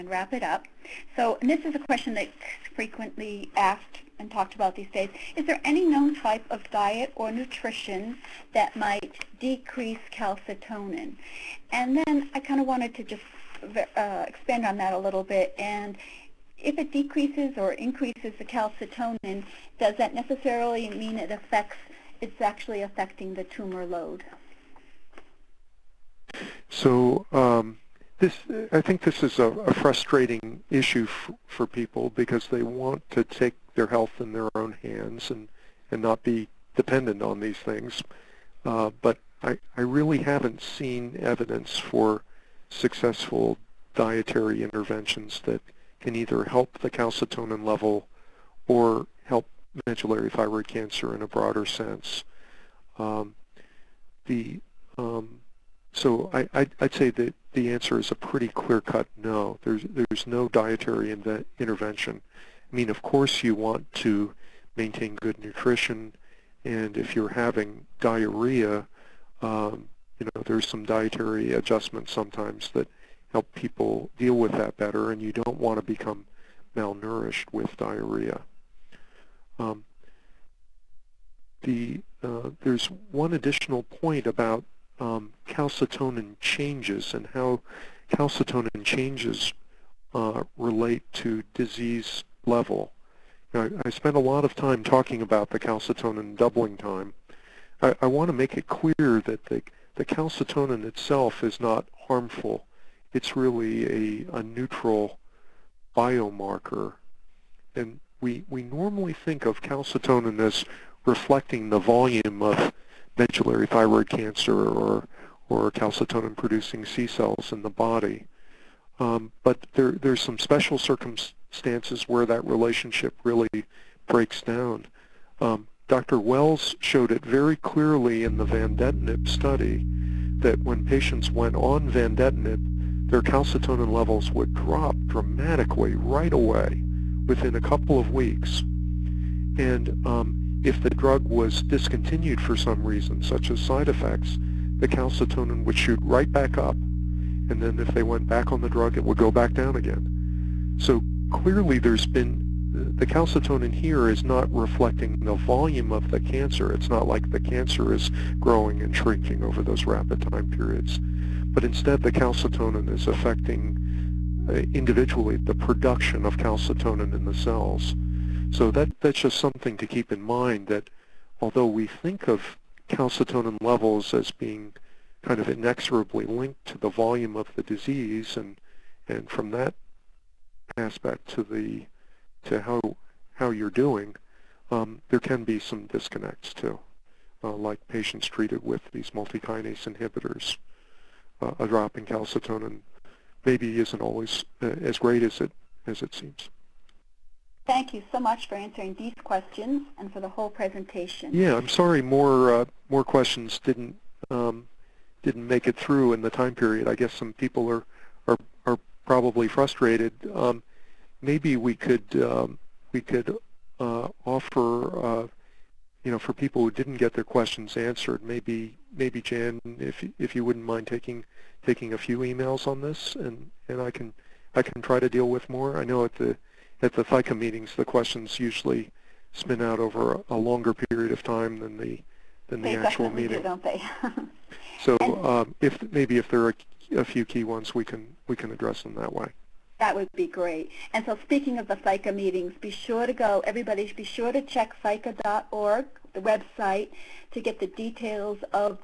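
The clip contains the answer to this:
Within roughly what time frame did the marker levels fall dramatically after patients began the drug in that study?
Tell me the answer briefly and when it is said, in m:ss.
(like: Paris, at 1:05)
a couple of weeks, at 2:17.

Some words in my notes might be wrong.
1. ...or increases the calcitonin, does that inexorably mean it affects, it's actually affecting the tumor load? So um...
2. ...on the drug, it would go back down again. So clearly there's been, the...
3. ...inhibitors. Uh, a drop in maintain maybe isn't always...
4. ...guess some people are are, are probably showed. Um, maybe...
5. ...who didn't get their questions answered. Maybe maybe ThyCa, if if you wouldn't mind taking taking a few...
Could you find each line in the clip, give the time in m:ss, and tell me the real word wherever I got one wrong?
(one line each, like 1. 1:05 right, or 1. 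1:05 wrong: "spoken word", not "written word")
1. 0:17 wrong: "necessarily", not "inexorably"
2. 2:28 right
3. 3:09 wrong: "calcitonin", not "maintain"
4. 3:26 wrong: "frustrated", not "showed"
5. 3:36 wrong: "Jan", not "ThyCa".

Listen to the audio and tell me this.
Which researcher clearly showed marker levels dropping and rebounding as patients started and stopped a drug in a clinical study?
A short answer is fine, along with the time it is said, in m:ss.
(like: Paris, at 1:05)
Dr. Wells, at 2:05.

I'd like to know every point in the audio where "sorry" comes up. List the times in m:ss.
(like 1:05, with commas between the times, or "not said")
3:21.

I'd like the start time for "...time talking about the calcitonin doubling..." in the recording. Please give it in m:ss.
1:34.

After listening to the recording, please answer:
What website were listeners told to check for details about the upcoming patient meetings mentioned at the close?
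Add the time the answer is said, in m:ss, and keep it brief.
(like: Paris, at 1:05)
ThyCa.org, at 4:04.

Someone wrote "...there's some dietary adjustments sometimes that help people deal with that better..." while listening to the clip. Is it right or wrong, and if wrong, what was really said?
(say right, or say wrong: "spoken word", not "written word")
right.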